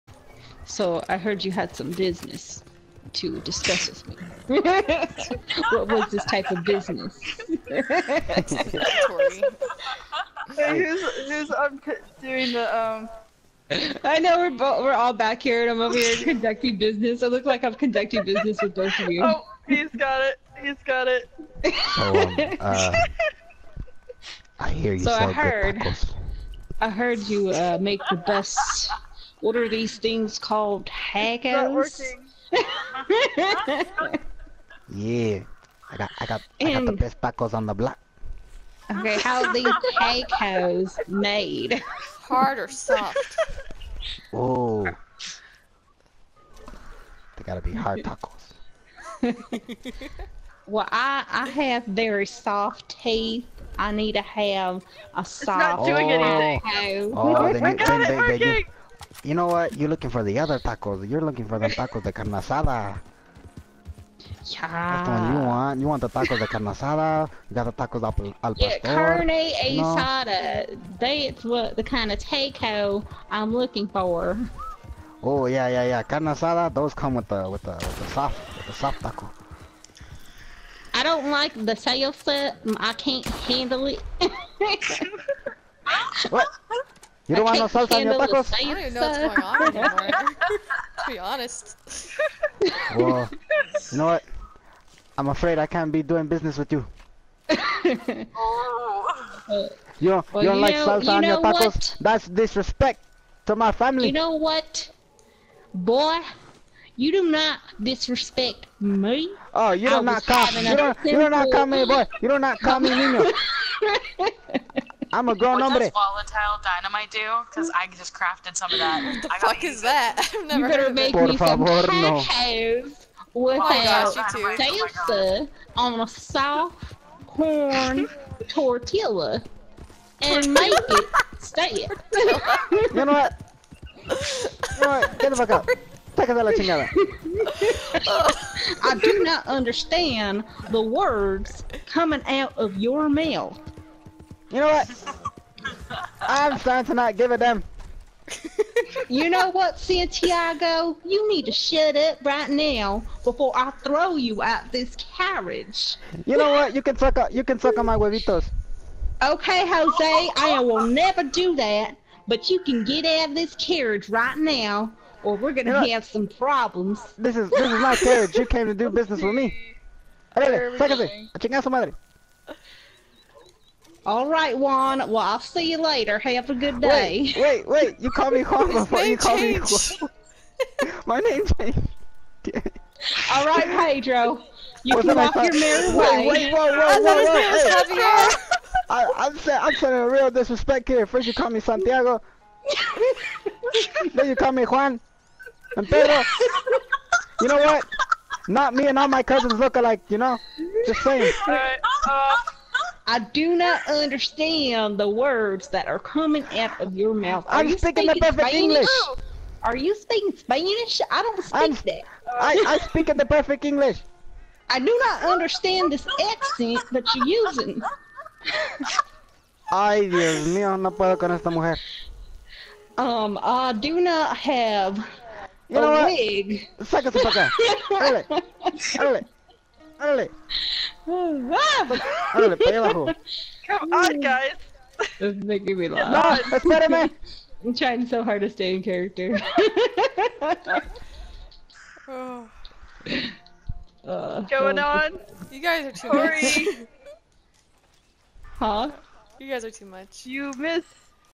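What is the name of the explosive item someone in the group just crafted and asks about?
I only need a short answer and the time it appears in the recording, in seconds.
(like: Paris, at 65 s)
volatile dynamite, at 116 s.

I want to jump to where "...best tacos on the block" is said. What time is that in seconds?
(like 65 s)
36 s.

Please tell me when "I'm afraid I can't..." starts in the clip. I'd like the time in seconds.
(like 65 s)
95 s.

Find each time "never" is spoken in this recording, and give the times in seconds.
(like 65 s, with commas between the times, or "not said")
120 s, 160 s.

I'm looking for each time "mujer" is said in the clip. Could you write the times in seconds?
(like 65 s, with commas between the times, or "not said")
221 s.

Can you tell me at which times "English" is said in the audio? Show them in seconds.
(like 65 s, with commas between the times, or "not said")
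208 s, 213 s.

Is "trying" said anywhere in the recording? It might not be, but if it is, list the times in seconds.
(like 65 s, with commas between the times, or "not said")
237 s.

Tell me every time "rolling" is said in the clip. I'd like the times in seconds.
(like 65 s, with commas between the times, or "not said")
not said.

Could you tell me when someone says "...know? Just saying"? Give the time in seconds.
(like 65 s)
200 s.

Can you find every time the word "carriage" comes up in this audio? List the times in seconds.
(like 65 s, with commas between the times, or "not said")
155 s, 163 s, 167 s.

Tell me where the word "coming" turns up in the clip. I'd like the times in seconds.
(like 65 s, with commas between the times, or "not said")
141 s, 205 s.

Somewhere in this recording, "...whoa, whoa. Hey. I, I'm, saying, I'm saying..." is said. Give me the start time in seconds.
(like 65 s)
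187 s.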